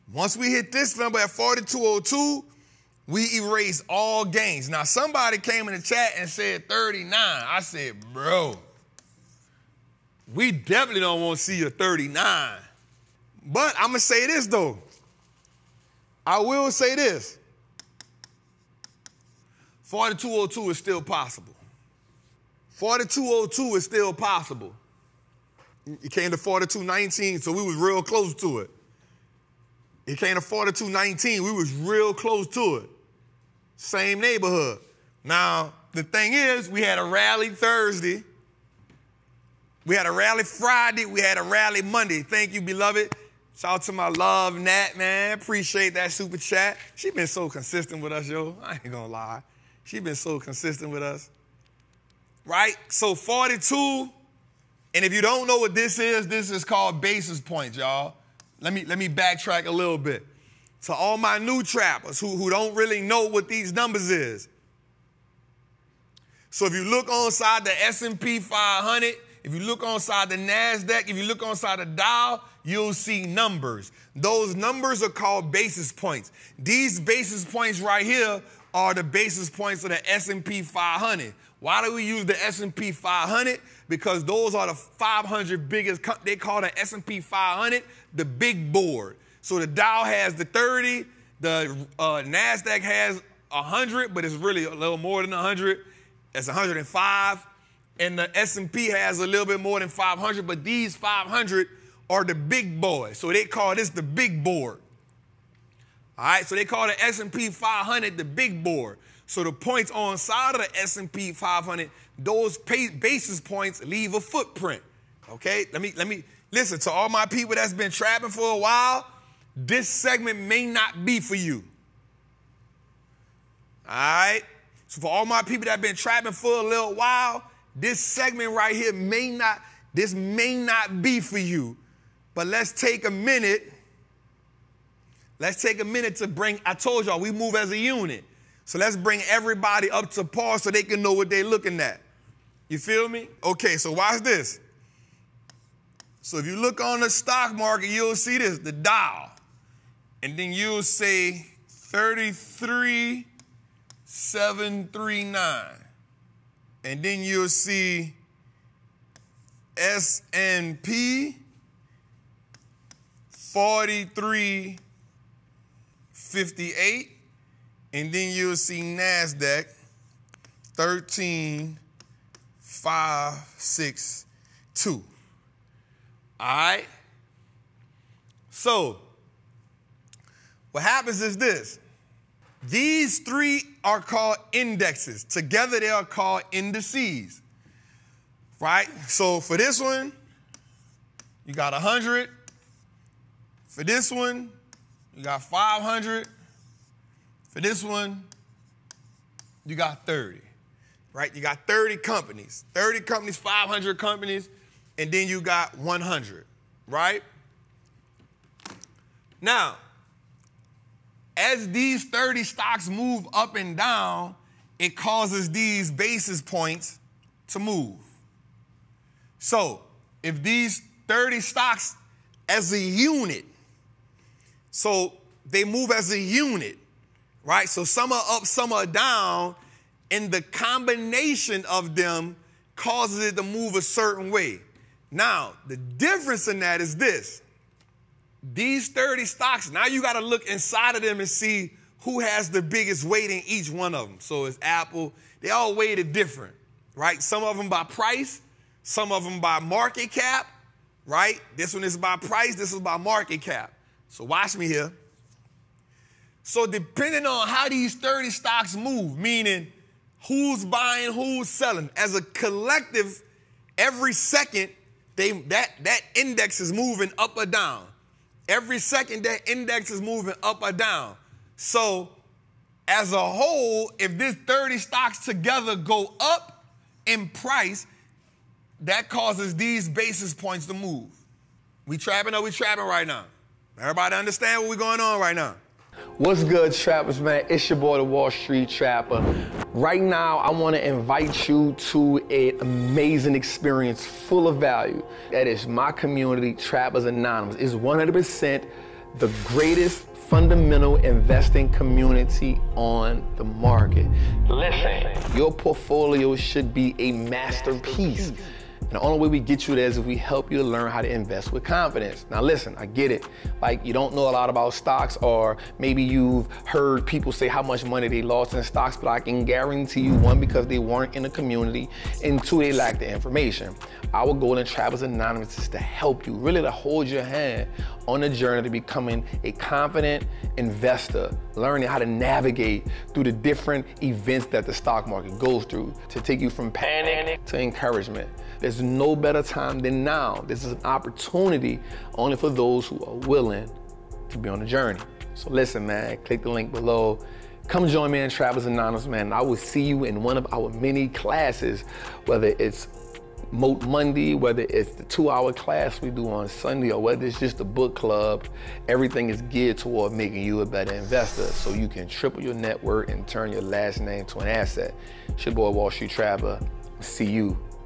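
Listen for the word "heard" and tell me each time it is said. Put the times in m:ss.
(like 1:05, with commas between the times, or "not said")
5:16.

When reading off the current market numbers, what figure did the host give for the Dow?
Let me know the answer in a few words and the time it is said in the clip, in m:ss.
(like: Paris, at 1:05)
33739, at 2:31.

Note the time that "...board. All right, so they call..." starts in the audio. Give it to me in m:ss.
1:44.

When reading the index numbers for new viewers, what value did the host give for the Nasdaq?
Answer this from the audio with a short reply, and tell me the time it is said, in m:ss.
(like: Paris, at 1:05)
13562, at 2:50.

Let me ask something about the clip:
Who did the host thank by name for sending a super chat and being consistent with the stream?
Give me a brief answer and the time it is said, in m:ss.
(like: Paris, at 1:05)
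Nat, at 0:44.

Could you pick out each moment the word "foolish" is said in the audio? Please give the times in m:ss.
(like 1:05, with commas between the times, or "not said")
not said.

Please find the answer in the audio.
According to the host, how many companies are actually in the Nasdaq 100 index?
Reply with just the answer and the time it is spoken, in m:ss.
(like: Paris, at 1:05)
105, at 1:36.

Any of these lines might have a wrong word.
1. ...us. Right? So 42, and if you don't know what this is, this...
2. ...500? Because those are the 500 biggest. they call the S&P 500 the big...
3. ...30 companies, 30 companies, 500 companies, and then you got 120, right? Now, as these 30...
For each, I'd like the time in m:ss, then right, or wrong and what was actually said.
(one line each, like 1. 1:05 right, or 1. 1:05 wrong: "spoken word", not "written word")
1. 0:51 right
2. 1:22 right
3. 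3:21 wrong: "100", not "120".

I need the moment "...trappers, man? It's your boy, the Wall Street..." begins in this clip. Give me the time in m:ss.
4:46.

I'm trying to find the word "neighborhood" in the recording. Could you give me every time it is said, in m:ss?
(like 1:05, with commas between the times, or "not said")
0:34.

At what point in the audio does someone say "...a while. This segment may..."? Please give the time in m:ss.
1:58.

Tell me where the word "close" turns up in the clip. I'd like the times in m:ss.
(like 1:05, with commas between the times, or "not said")
0:28, 0:32.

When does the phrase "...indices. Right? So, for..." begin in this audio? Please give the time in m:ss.
3:06.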